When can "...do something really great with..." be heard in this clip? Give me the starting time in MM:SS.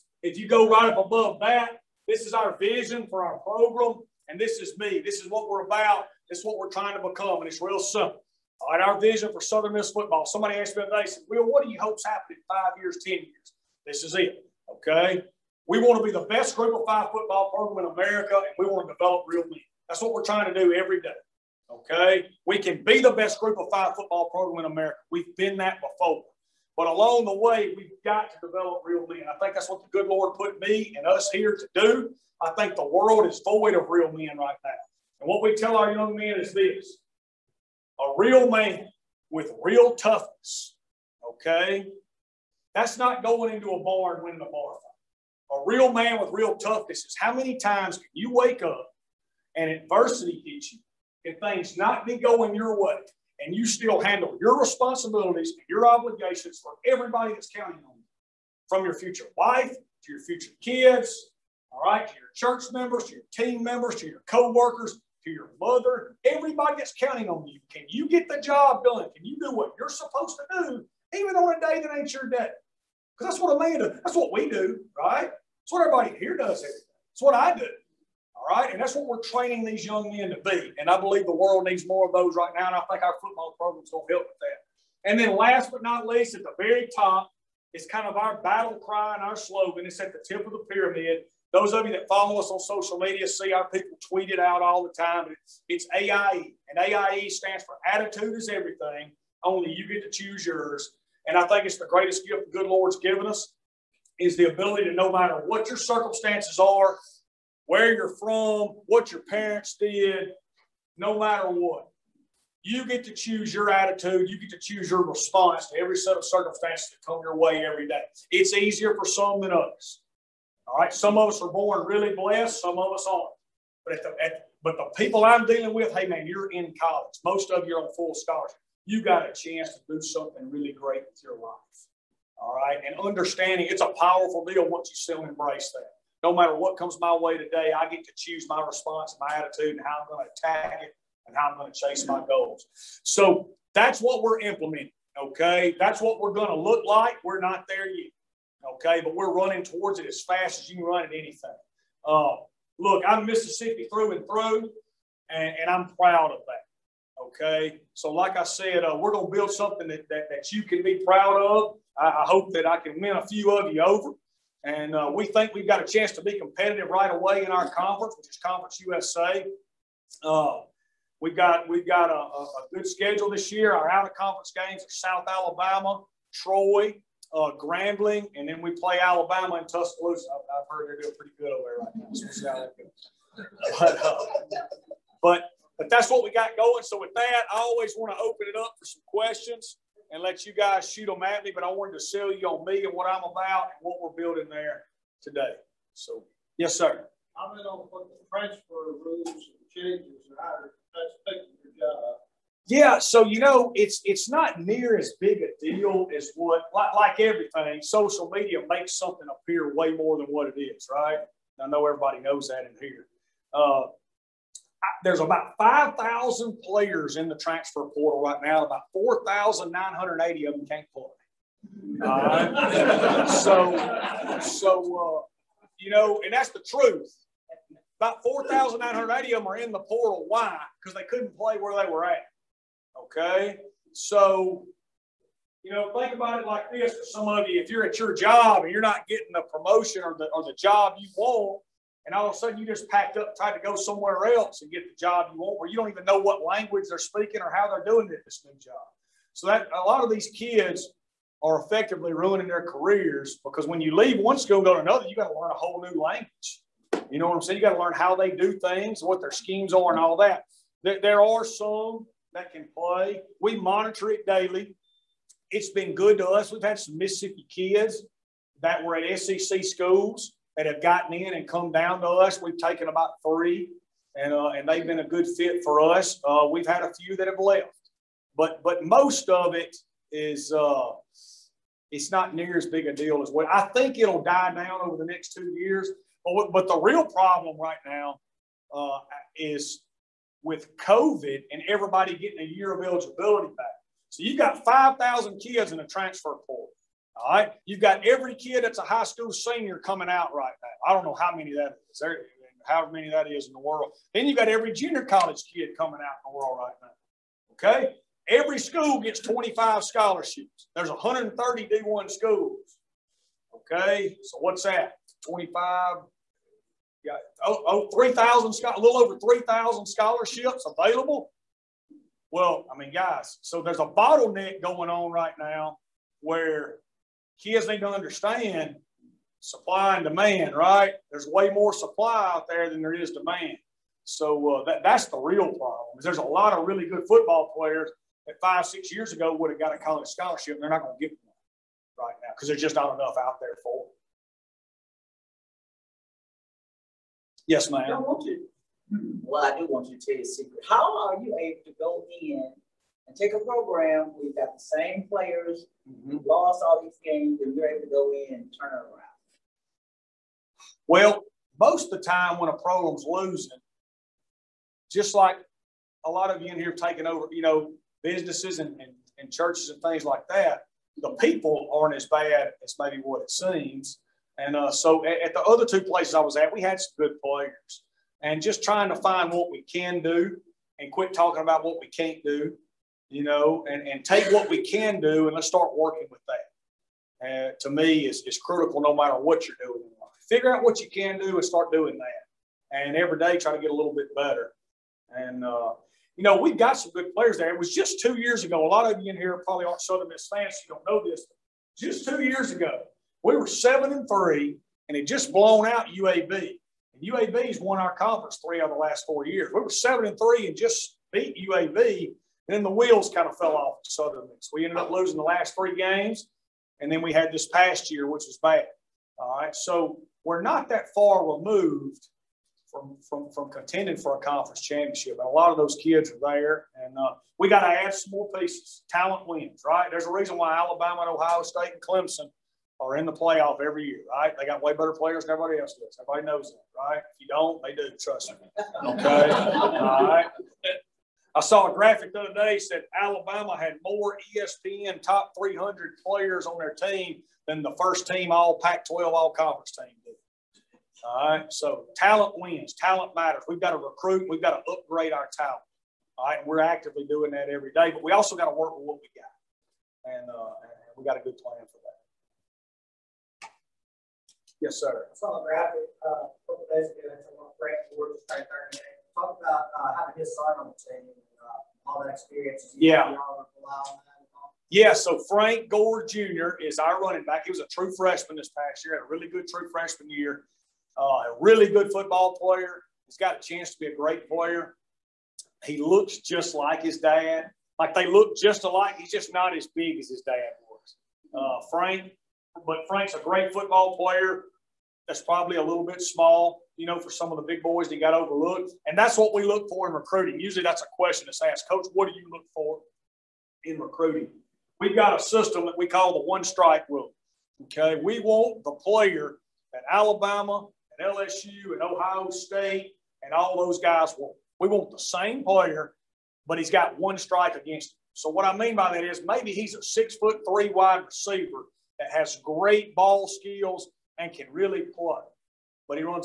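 02:09.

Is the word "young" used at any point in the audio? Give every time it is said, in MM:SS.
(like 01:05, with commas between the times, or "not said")
00:35, 01:19.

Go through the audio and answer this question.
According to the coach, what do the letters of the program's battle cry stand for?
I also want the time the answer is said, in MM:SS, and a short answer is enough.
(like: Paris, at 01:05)
Attitude is Everything, at 01:37.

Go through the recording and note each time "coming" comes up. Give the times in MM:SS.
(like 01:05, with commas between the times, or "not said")
04:59, 05:05.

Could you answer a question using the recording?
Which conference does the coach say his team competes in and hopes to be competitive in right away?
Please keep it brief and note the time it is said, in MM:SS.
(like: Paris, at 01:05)
Conference USA, at 02:48.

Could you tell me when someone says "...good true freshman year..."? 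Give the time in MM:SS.
07:59.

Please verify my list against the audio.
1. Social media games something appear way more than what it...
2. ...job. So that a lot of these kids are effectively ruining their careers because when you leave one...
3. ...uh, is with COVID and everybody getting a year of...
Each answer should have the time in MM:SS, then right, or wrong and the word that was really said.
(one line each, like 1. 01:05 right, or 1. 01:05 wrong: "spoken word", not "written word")
1. 03:27 wrong: "makes", not "games"
2. 04:08 right
3. 04:48 right.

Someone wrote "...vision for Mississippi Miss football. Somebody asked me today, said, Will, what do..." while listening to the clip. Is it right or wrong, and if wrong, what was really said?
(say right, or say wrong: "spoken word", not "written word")
wrong: "Southern", not "Mississippi".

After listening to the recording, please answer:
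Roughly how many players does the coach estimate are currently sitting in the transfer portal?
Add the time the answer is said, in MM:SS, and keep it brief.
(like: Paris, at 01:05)
5,000, at 03:35.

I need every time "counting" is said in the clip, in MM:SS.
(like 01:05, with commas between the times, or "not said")
00:57, 01:06.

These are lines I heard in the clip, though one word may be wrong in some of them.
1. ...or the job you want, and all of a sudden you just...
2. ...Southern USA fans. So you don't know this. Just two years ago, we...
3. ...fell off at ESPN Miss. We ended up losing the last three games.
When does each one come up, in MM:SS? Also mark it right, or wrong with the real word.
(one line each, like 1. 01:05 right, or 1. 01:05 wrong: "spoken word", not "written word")
1. 04:00 right
2. 06:39 wrong: "Miss", not "USA"
3. 06:53 wrong: "Southern", not "ESPN".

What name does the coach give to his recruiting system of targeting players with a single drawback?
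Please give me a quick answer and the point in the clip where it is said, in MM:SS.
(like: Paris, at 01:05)
one strike rule, at 08:26.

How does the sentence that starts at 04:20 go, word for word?
There, there are some that can play.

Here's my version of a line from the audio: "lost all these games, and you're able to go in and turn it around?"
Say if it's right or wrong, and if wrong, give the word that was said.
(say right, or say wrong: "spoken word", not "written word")
right.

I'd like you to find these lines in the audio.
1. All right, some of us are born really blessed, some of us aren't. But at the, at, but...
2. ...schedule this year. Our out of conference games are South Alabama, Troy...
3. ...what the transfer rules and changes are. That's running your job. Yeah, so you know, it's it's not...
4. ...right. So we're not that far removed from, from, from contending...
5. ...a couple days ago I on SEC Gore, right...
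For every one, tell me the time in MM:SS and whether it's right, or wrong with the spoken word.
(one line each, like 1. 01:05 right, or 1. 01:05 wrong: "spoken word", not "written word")
1. 02:00 right
2. 02:52 right
3. 03:17 wrong: "taking", not "running"
4. 06:59 right
5. 07:46 wrong: "Frank", not "SEC".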